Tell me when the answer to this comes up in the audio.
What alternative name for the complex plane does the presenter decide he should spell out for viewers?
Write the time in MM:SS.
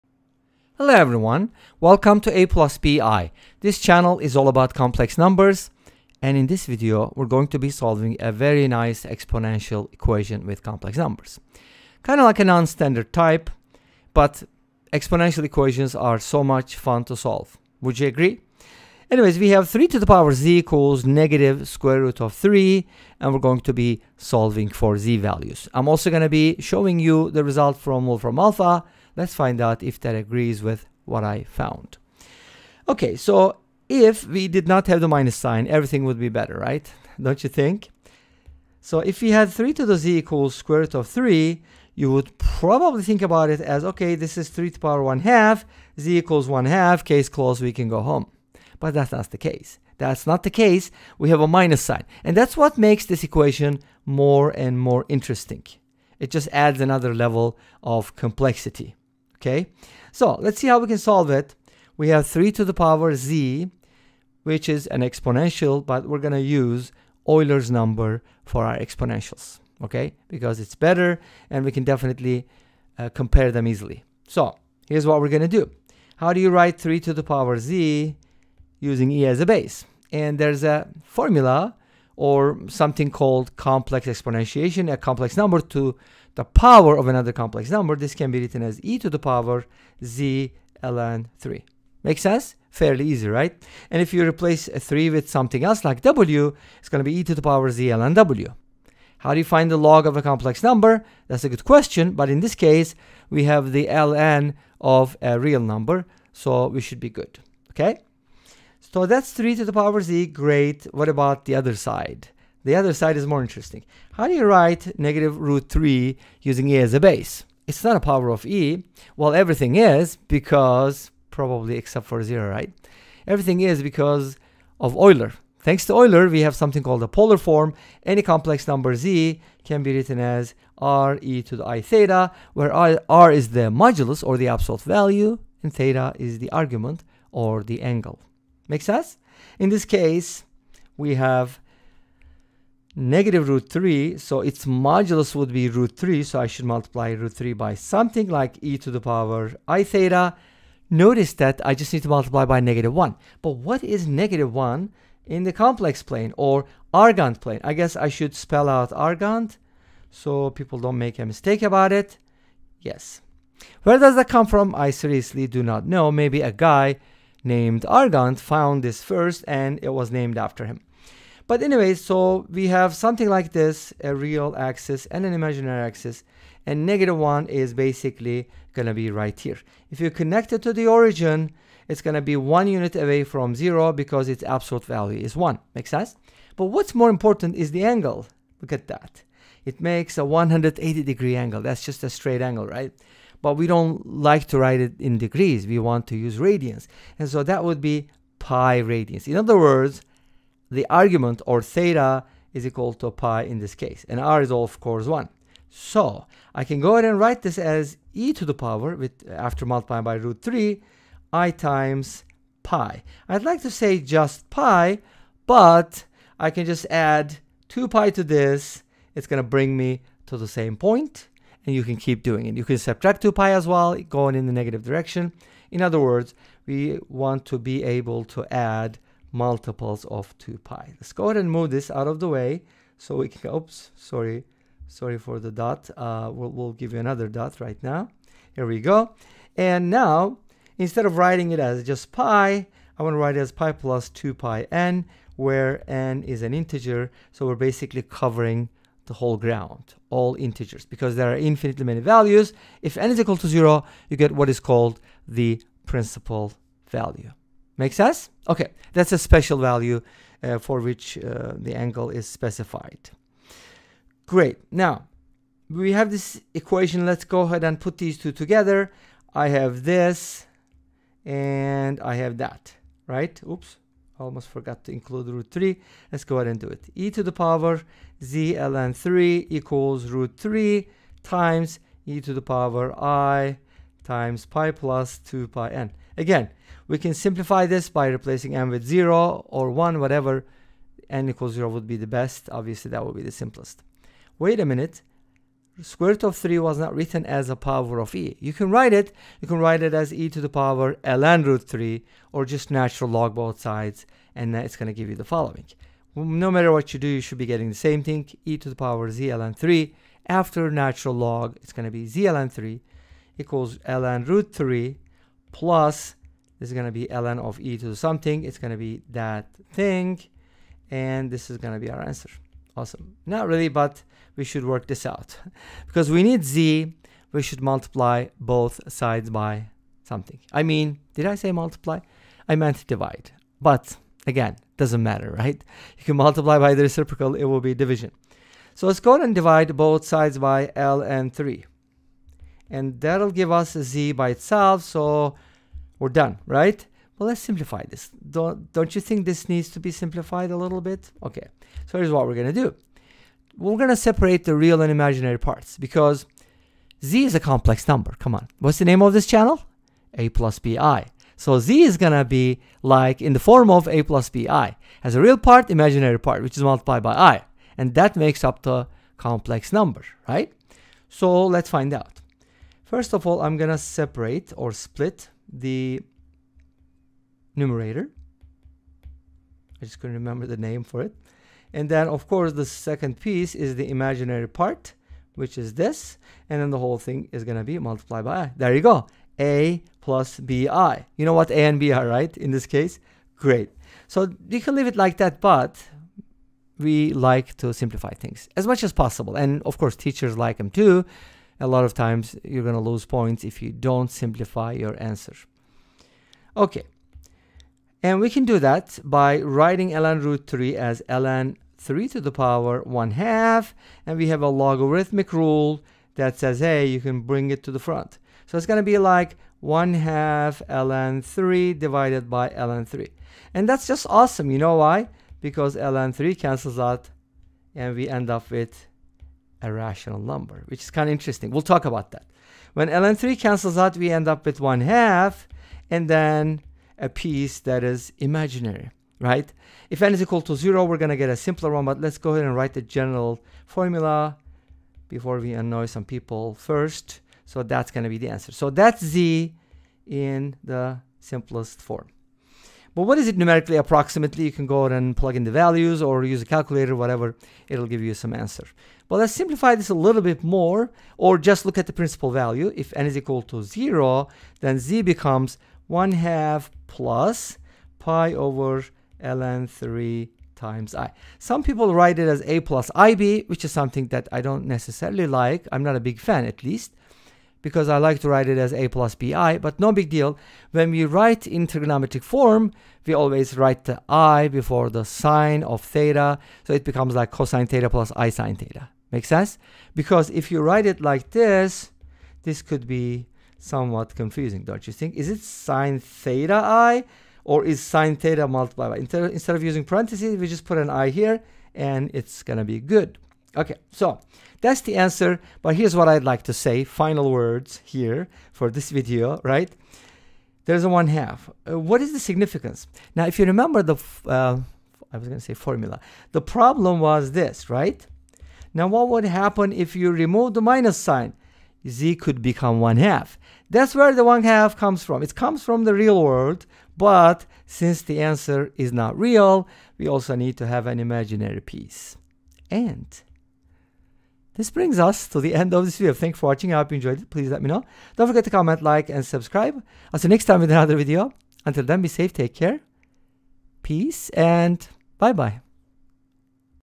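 02:36.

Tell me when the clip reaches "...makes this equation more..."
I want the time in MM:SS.
00:52.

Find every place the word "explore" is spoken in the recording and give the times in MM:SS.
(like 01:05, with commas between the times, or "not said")
not said.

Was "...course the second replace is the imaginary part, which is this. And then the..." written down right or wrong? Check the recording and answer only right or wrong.
wrong.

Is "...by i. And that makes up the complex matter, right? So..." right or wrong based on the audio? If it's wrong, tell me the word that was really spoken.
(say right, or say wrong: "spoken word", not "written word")
wrong: "number", not "matter".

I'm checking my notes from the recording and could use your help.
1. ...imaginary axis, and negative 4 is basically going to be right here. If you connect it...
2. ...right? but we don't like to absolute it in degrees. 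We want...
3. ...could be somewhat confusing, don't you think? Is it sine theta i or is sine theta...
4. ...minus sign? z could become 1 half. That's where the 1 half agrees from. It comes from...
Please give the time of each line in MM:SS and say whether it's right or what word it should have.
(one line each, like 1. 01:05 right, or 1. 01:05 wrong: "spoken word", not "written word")
1. 02:55 wrong: "1", not "4"
2. 03:12 wrong: "write", not "absolute"
3. 08:12 right
4. 08:40 wrong: "comes", not "agrees".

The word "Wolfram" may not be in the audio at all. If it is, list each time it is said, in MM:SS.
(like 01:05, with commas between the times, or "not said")
00:28.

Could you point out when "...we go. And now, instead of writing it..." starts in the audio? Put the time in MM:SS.
03:58.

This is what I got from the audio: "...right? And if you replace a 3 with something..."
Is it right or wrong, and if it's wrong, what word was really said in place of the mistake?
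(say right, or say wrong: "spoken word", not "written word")
right.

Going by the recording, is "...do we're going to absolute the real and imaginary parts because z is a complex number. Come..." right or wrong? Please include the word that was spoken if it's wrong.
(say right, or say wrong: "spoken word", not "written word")
wrong: "separate", not "absolute".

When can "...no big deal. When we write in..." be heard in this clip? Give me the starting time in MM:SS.
07:59.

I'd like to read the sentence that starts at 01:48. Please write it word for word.
So that's 3 to the power z, great.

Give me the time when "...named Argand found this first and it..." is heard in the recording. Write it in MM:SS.
02:47.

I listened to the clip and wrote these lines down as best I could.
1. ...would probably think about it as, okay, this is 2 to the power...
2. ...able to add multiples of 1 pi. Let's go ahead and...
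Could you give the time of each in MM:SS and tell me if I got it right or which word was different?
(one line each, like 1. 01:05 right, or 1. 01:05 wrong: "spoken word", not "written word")
1. 00:42 wrong: "3", not "2"
2. 03:47 wrong: "2", not "1".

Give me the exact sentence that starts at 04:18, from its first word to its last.
Okay, that's a special value uh, for which uh, the angle is specified.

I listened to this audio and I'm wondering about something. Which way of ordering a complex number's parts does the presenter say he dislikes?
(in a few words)
a plus ib.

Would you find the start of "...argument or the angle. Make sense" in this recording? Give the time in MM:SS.
02:16.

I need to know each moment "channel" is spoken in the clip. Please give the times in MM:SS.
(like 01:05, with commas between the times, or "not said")
00:03, 05:59.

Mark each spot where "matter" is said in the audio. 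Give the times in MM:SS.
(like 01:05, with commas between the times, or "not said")
05:06, 05:35.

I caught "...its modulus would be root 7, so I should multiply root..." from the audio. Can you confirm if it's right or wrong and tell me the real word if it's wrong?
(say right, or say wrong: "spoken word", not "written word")
wrong: "3", not "7".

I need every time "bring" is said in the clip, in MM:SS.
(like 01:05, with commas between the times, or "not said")
03:39, 06:57, 08:54.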